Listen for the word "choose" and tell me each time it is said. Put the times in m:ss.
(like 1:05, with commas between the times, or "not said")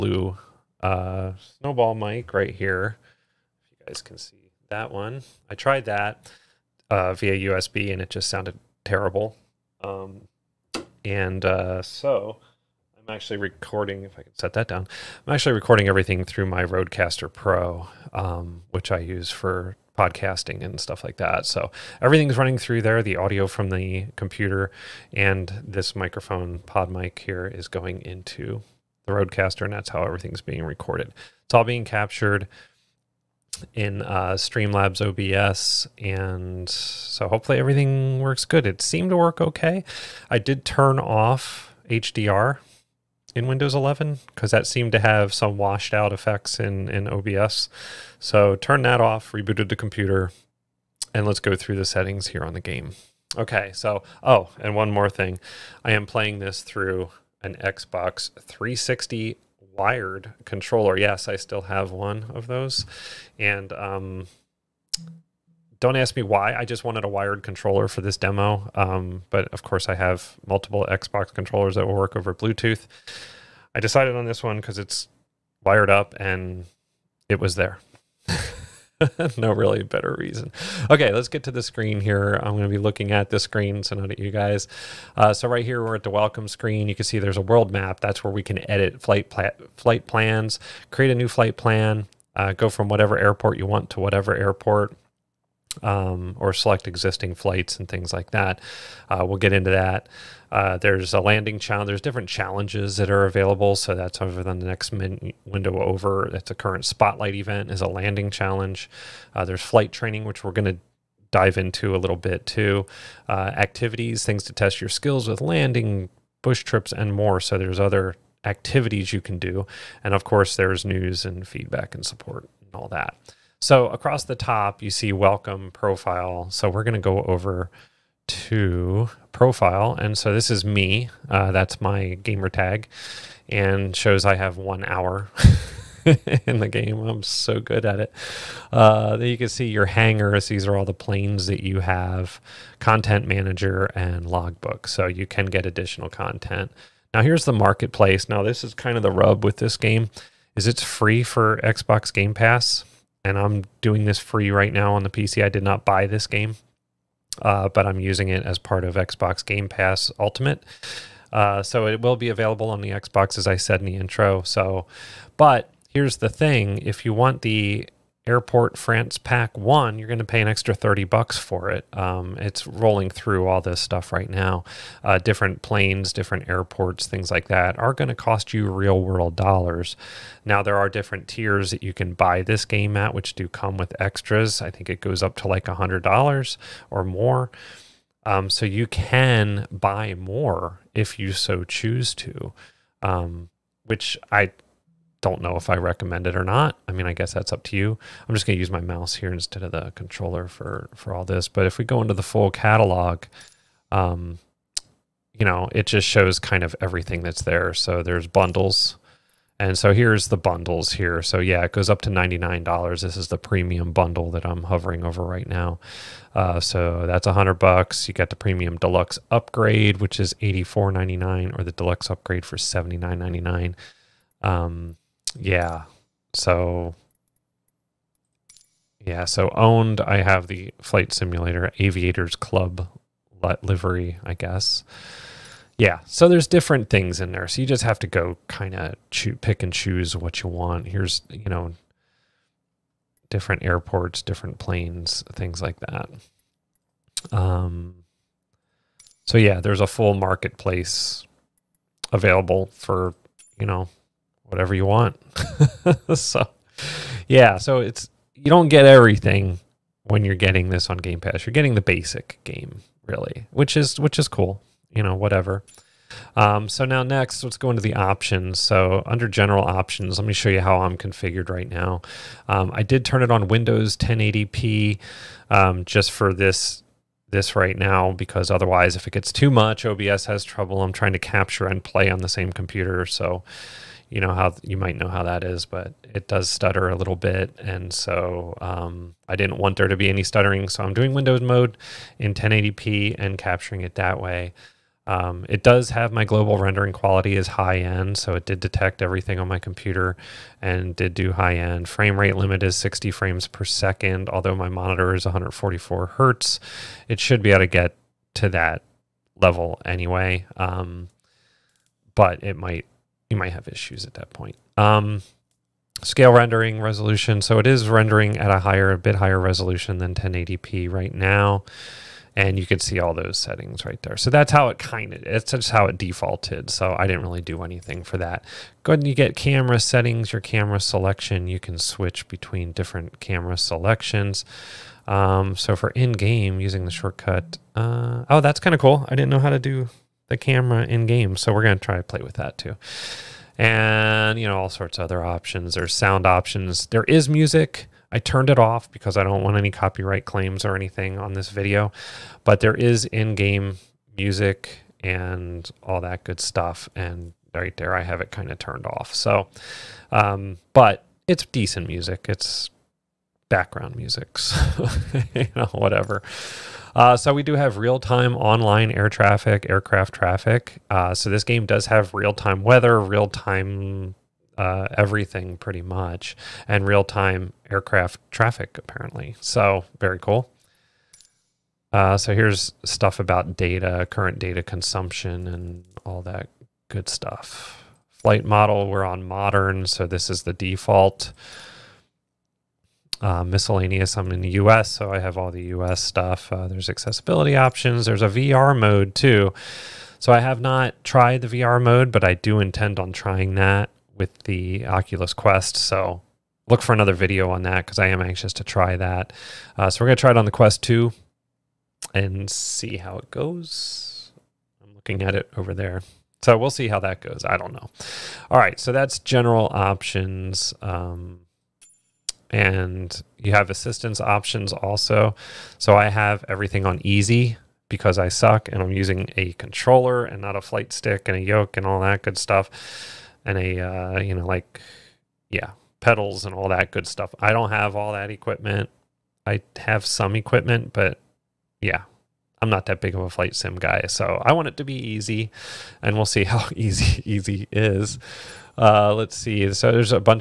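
3:11, 3:59.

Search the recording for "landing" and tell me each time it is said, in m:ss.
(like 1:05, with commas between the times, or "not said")
1:41, 1:47, 1:55.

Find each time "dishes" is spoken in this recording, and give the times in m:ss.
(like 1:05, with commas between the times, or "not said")
not said.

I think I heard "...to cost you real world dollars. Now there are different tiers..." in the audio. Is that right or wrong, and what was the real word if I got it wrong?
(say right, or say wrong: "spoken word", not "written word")
right.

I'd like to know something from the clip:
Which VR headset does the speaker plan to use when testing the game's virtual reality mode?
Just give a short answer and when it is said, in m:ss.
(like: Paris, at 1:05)
Oculus Quest 2, at 6:50.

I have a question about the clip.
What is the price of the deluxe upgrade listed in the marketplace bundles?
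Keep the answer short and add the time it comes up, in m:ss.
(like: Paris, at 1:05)
$79.99, at 3:42.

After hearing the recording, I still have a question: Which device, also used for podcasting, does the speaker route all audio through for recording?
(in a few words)
RodeCaster Pro.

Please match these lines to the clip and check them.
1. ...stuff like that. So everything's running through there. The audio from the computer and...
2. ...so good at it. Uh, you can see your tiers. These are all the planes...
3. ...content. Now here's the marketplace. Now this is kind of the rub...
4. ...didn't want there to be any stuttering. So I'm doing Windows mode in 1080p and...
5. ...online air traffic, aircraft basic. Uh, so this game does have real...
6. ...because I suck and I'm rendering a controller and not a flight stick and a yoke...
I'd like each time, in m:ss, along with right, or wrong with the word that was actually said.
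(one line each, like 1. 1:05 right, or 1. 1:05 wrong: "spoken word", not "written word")
1. 0:20 right
2. 2:17 wrong: "hangars", not "tiers"
3. 2:26 right
4. 4:49 right
5. 6:08 wrong: "traffic", not "basic"
6. 7:07 wrong: "using", not "rendering".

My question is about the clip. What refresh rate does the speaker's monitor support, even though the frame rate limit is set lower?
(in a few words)
144 hertz.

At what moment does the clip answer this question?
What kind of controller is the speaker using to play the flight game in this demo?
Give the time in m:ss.
0:57.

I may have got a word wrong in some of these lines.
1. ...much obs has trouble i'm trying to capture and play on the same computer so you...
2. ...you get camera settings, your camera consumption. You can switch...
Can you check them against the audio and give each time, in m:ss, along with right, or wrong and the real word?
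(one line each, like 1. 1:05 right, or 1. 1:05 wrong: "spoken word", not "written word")
1. 4:39 right
2. 5:29 wrong: "selection", not "consumption".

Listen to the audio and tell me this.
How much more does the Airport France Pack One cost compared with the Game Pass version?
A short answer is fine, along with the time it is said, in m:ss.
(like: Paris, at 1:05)
$30, at 2:50.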